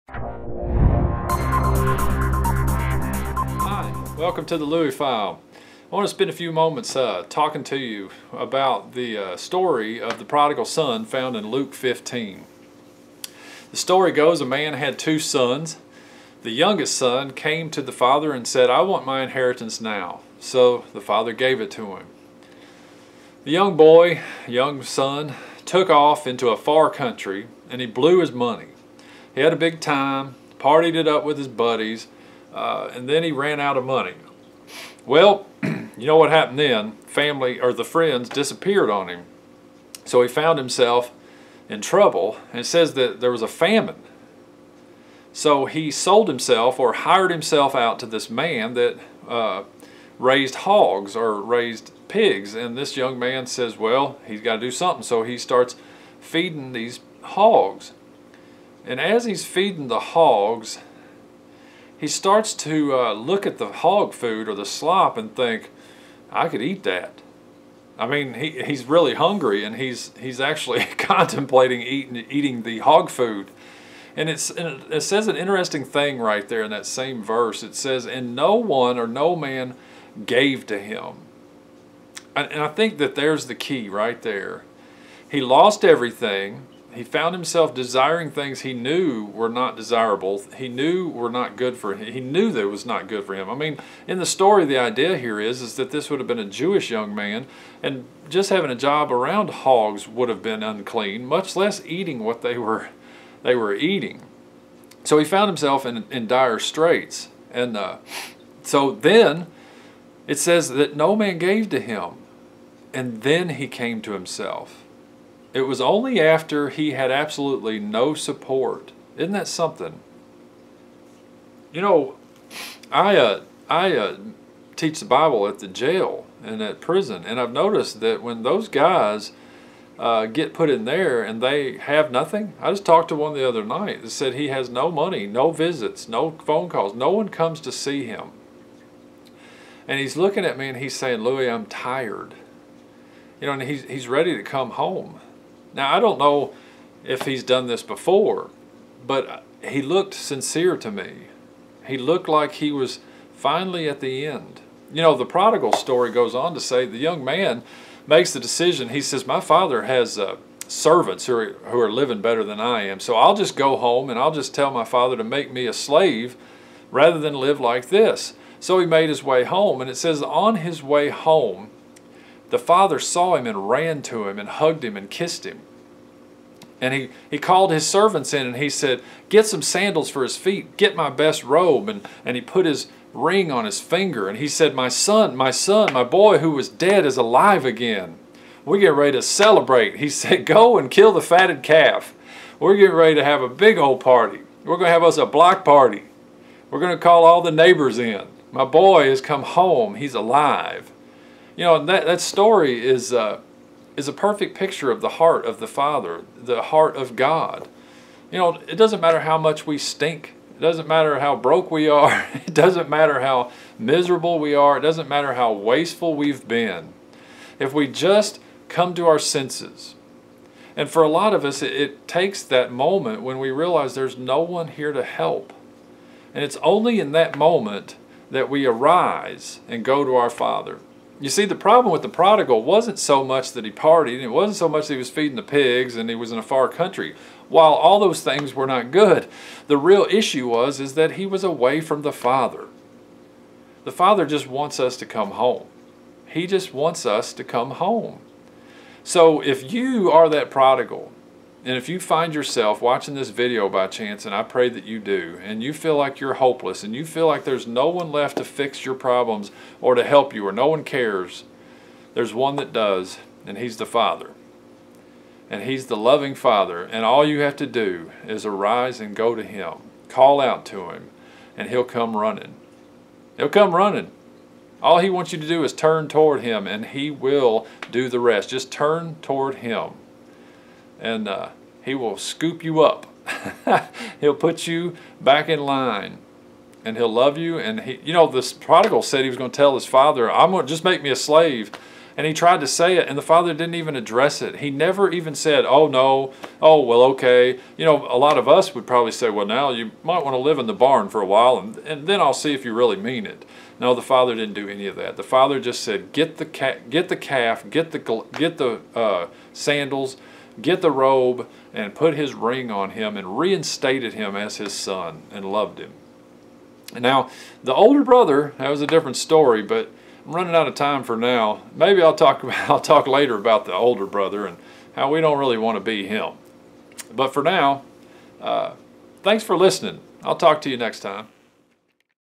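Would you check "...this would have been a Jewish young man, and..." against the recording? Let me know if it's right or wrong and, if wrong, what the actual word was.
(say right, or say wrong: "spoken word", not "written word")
right.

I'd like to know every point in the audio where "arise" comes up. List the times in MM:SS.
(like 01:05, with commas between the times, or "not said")
03:48, 04:28.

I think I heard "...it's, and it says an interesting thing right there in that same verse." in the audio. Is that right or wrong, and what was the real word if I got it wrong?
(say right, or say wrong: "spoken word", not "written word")
right.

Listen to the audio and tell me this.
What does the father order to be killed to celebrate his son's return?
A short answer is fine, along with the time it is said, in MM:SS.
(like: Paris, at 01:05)
The fatted calf, at 03:11.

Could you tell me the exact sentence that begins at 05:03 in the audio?
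No, the father didn't do any of that.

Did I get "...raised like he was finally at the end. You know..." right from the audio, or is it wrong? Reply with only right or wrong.
wrong.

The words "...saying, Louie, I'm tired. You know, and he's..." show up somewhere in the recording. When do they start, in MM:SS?
02:20.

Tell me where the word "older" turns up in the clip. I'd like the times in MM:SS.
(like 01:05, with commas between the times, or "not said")
05:17, 05:23.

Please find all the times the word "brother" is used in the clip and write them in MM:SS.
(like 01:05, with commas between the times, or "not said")
05:18, 05:24.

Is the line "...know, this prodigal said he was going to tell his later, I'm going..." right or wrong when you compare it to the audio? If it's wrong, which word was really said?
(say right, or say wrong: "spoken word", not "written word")
wrong: "father", not "later".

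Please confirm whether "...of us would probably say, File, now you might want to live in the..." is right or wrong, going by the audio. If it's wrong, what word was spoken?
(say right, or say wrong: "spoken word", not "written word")
wrong: "Well", not "File".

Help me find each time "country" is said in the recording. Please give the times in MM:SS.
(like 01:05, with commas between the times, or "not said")
00:26, 03:56.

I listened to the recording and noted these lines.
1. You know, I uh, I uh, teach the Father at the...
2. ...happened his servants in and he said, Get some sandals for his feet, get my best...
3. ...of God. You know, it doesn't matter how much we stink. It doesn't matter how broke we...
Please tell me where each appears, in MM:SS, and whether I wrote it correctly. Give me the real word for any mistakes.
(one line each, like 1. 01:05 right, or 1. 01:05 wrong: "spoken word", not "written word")
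1. 02:01 wrong: "Bible", not "Father"
2. 02:57 wrong: "called", not "happened"
3. 03:26 right.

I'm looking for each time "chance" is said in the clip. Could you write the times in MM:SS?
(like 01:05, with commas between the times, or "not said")
04:13.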